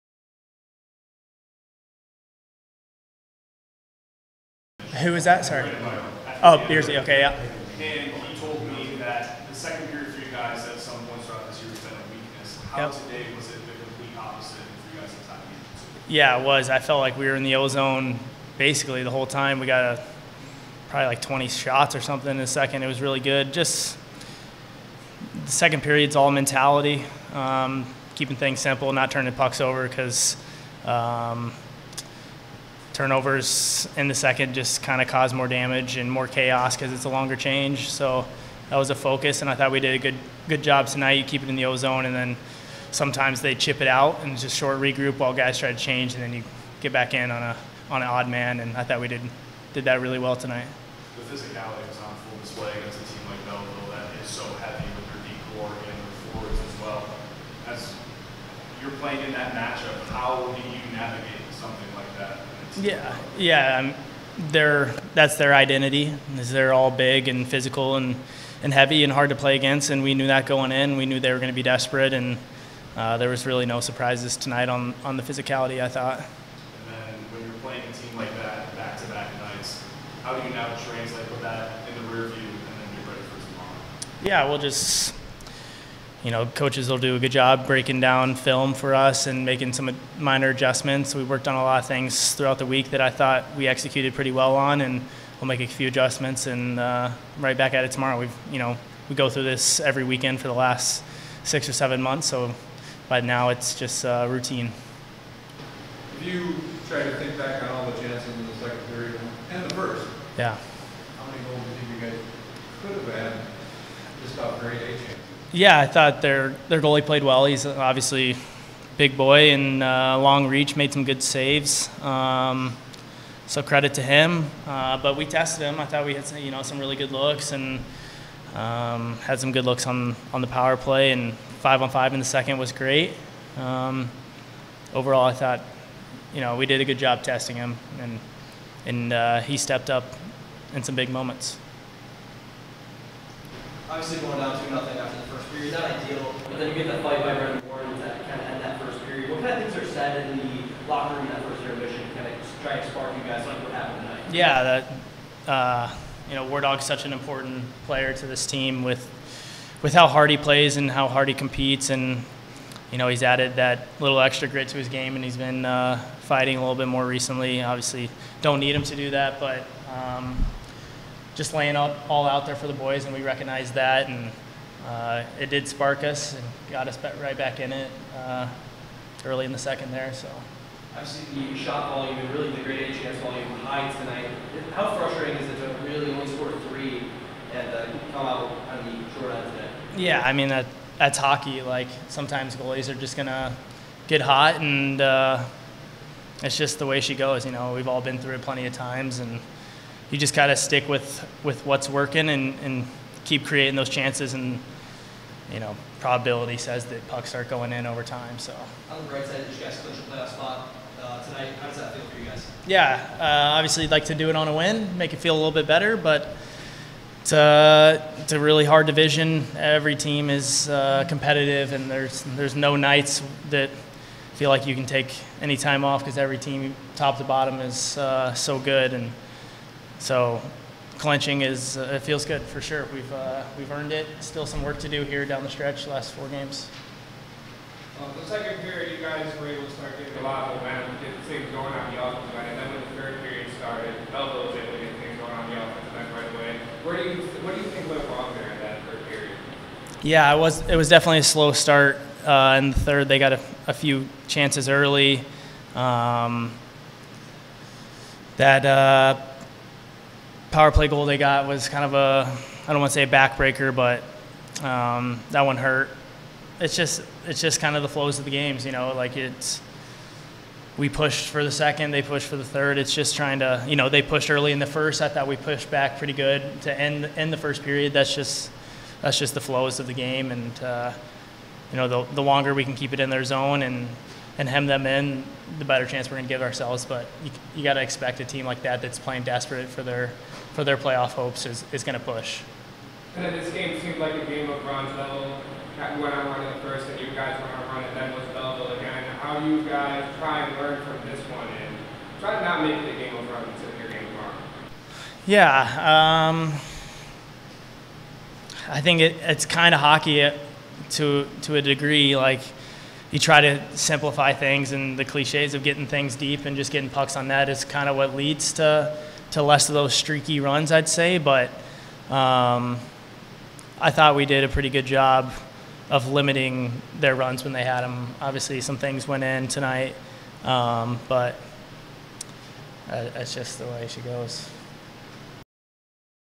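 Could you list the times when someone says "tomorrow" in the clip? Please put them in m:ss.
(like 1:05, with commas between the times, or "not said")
1:23, 1:37, 5:04.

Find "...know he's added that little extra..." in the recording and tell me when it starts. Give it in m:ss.
2:42.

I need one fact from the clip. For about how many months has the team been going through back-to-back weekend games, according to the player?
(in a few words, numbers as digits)
6 or 7 months.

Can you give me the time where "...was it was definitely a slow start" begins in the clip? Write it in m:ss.
4:10.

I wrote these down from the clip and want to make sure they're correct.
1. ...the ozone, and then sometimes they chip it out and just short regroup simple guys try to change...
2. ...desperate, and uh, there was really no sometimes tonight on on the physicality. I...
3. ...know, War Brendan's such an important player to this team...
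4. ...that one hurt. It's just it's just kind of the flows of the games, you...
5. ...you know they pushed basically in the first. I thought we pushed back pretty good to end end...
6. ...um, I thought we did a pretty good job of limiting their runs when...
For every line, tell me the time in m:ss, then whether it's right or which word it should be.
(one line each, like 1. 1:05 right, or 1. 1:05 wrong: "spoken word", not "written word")
1. 0:41 wrong: "while", not "simple"
2. 1:11 wrong: "surprises", not "sometimes"
3. 2:36 wrong: "Dog", not "Brendan"
4. 4:25 right
5. 4:33 wrong: "early", not "basically"
6. 5:22 right.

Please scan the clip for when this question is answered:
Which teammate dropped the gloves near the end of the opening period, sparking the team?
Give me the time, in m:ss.
2:27.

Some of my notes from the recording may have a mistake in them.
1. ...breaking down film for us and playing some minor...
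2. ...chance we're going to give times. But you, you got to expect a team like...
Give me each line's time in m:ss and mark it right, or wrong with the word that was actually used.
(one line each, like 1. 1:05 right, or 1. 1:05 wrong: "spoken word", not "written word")
1. 1:27 wrong: "making", not "playing"
2. 4:45 wrong: "ourselves", not "times".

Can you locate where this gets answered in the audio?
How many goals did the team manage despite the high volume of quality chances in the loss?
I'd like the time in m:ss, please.
3:06.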